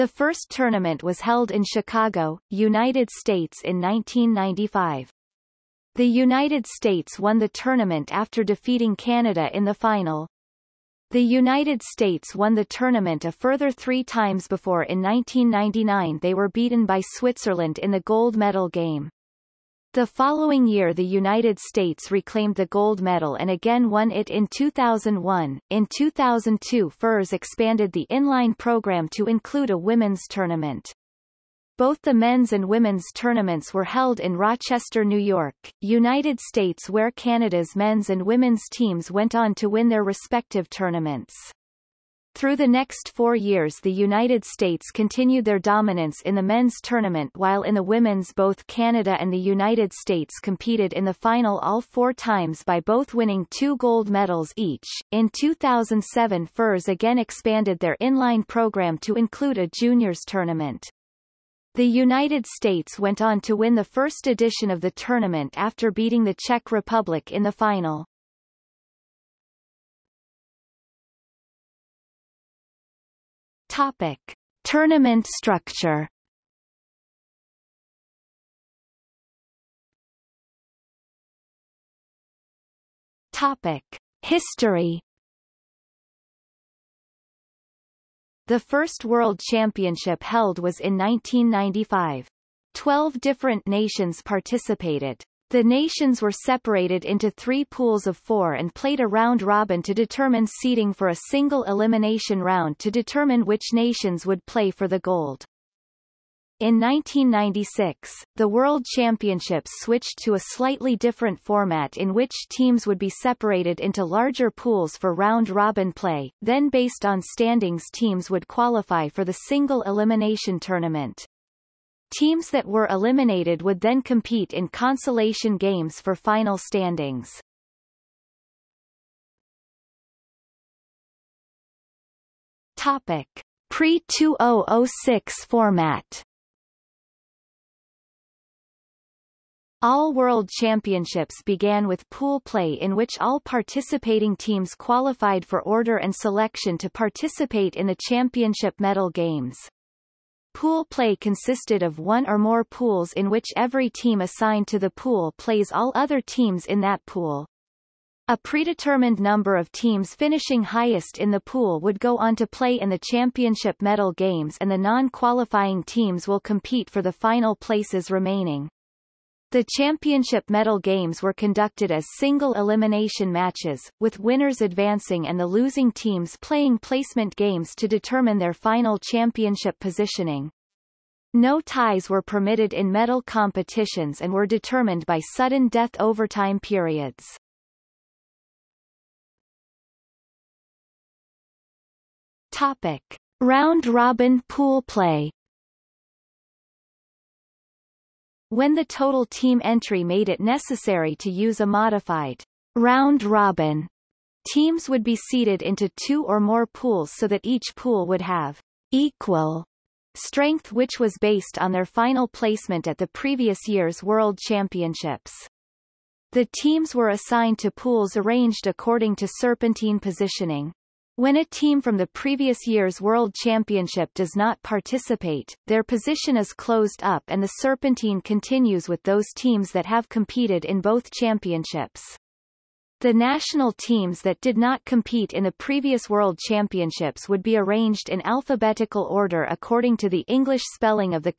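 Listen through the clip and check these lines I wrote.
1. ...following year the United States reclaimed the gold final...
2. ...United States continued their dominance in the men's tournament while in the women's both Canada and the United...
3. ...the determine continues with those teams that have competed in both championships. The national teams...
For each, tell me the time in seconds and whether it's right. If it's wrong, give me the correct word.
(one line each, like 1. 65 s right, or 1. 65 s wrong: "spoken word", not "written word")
1. 20 s wrong: "medal", not "final"
2. 43 s right
3. 227 s wrong: "serpentine", not "determine".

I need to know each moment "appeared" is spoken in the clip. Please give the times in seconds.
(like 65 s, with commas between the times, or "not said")
not said.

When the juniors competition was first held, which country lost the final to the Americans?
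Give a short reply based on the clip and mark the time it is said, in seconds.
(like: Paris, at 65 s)
Czech Republic, at 66 s.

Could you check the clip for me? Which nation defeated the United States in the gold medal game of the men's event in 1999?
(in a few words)
Switzerland.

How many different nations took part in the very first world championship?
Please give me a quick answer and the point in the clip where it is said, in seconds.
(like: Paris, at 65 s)
12, at 92 s.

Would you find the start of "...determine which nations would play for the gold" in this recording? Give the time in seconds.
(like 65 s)
102 s.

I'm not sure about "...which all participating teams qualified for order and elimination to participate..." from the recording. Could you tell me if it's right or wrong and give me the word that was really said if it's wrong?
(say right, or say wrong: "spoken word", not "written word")
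wrong: "selection", not "elimination".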